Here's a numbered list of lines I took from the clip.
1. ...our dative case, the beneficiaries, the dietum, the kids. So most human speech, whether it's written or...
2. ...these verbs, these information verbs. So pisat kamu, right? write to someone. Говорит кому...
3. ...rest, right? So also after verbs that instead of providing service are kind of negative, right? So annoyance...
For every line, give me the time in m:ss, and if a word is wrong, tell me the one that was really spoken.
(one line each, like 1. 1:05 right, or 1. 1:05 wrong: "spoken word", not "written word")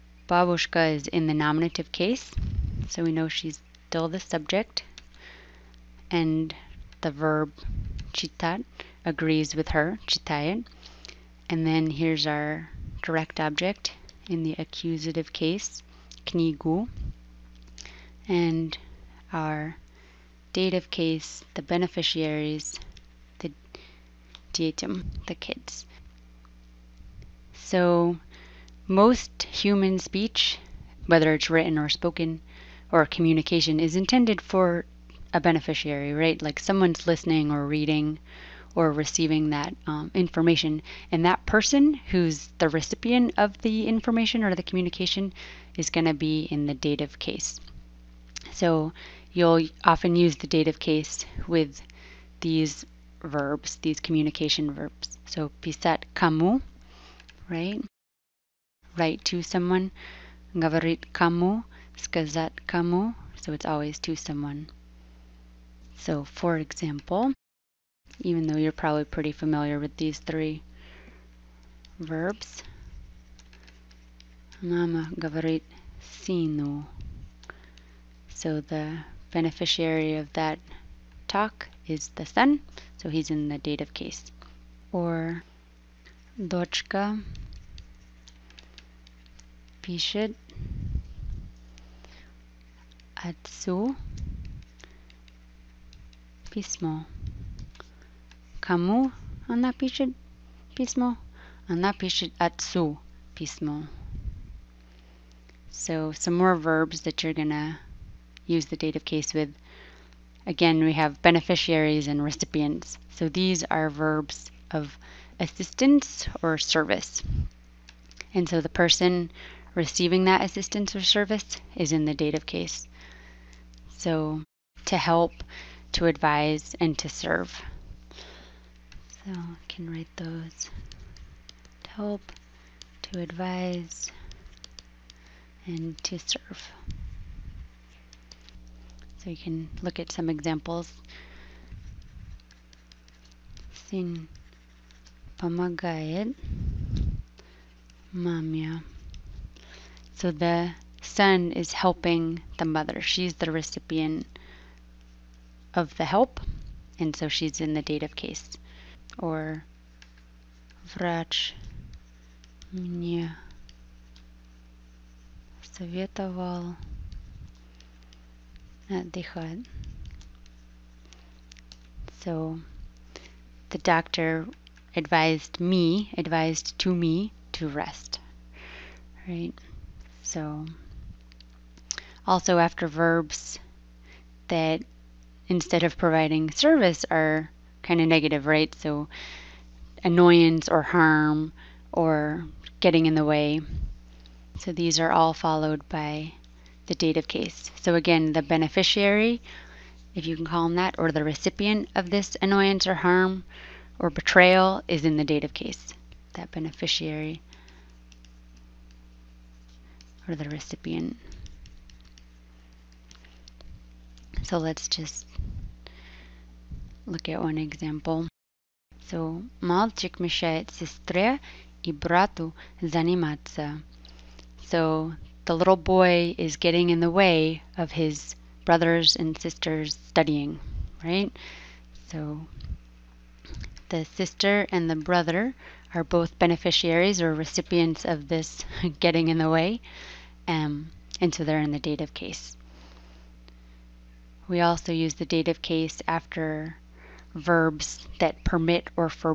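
1. 0:19 right
2. 0:52 wrong: "communication", not "information"
3. 2:57 right.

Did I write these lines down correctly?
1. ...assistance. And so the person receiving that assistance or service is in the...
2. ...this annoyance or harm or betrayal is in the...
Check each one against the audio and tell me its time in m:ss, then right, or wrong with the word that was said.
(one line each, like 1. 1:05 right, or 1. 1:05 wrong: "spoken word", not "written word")
1. 1:56 wrong: "service", not "assistance"
2. 3:22 right.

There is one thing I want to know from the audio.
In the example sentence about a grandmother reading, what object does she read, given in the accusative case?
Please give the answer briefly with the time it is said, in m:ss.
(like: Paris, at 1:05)
knigu, at 0:16.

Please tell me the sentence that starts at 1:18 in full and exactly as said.
So the beneficiary of that talk is the son, so he's in the dative case.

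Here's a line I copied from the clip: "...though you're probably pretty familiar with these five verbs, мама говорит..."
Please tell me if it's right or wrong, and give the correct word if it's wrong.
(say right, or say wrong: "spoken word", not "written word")
wrong: "three", not "five".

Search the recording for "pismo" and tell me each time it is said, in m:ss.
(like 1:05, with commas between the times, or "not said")
1:36, 1:43.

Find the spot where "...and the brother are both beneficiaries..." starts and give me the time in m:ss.
3:54.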